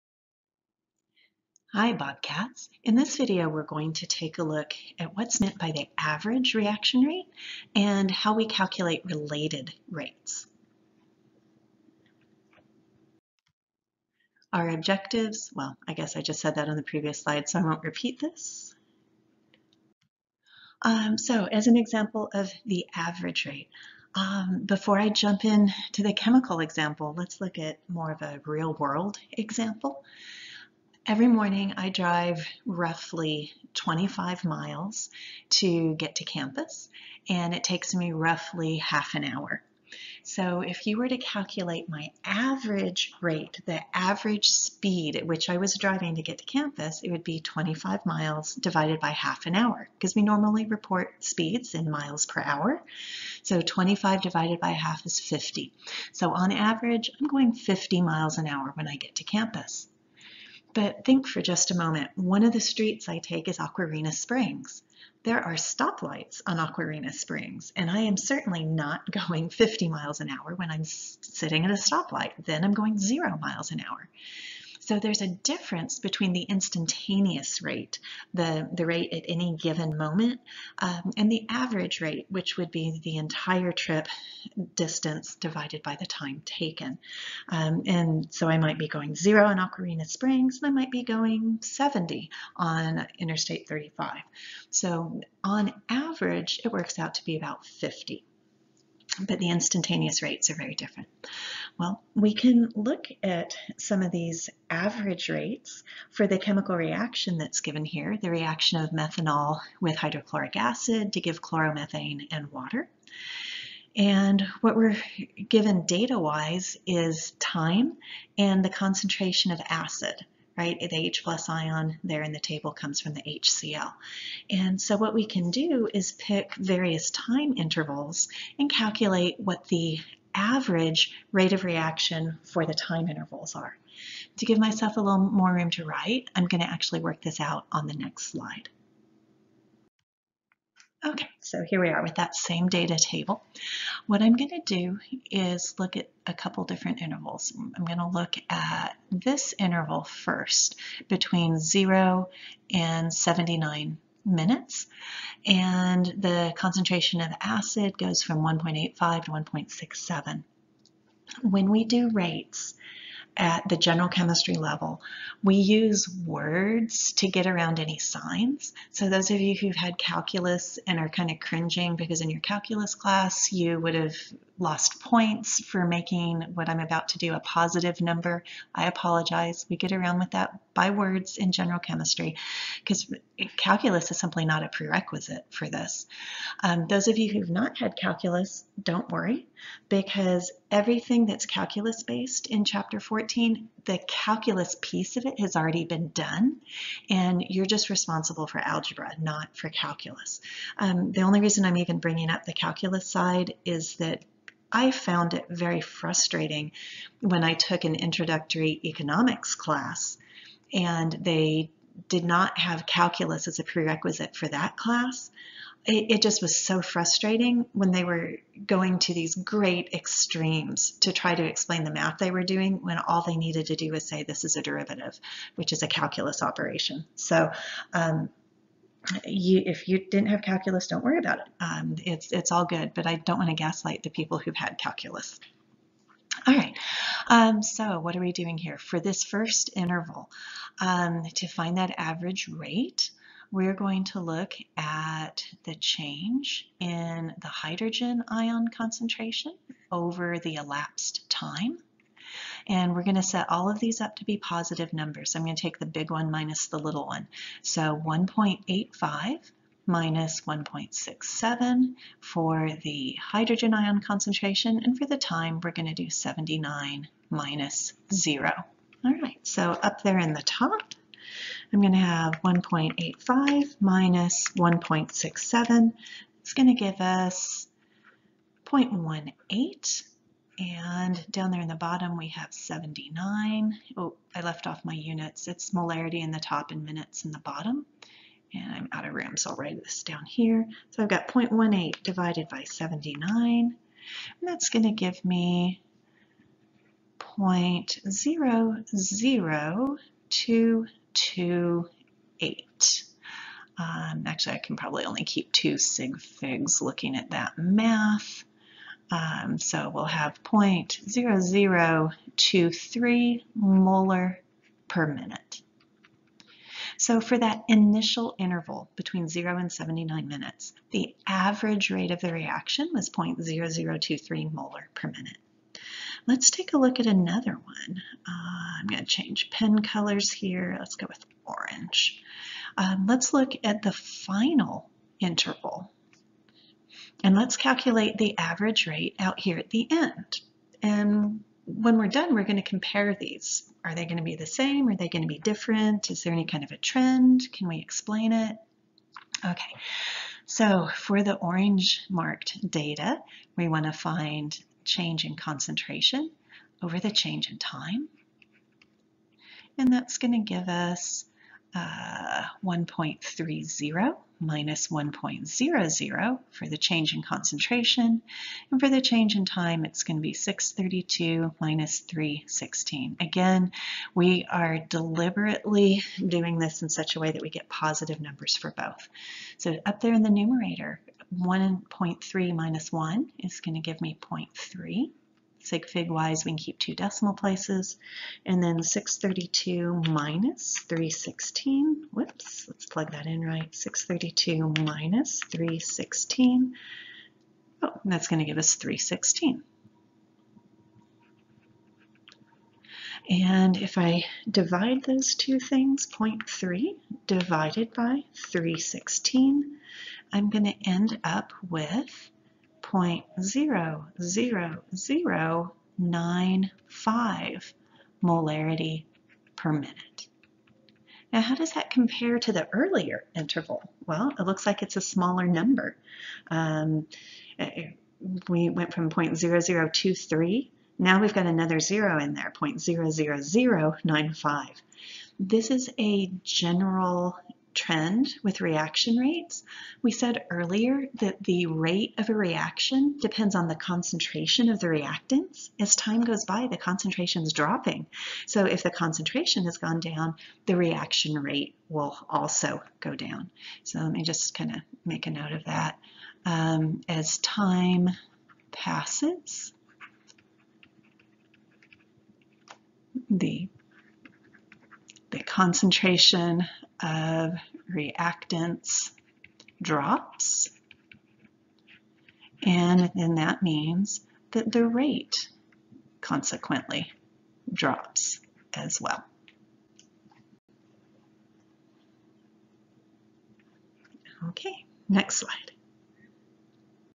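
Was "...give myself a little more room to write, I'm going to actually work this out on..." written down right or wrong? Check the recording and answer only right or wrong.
right.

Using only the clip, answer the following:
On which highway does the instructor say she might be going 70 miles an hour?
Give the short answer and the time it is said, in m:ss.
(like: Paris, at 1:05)
Interstate 35, at 1:33.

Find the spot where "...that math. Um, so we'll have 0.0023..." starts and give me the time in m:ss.
5:07.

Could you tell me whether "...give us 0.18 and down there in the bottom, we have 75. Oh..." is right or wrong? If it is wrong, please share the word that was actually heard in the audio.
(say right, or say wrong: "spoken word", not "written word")
wrong: "79", not "75".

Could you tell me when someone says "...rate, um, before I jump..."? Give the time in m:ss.
0:23.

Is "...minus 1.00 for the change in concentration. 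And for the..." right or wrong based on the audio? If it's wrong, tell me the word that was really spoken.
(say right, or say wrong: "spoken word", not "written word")
right.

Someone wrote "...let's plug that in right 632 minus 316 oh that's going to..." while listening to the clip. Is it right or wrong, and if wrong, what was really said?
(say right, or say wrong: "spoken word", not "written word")
right.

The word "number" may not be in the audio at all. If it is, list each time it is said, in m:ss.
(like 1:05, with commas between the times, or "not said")
2:57, 4:14, 6:18, 7:05.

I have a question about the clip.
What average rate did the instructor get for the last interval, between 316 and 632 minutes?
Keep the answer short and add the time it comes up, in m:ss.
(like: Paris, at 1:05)
0.00095 M/min, at 6:52.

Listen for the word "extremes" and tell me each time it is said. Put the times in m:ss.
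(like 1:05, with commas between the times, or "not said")
3:39.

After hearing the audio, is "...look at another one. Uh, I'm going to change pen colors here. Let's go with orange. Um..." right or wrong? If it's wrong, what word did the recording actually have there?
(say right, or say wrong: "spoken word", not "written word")
right.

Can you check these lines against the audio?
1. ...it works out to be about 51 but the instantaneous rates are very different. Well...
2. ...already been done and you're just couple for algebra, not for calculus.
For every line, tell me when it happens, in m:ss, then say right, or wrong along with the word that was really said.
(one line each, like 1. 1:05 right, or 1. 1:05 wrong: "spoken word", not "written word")
1. 1:36 wrong: "50", not "51"
2. 3:15 wrong: "responsible", not "couple".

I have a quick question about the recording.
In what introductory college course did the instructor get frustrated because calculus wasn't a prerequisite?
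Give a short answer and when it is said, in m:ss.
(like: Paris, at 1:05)
economics, at 3:28.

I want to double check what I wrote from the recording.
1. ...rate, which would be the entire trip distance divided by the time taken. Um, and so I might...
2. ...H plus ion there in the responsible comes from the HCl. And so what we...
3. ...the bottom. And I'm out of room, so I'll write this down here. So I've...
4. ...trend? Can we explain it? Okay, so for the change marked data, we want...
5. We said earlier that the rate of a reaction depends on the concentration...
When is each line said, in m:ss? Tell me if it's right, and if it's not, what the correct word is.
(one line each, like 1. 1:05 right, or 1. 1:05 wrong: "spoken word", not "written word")
1. 1:22 right
2. 2:01 wrong: "table", not "responsible"
3. 4:47 right
4. 5:46 wrong: "orange", not "change"
5. 7:20 right.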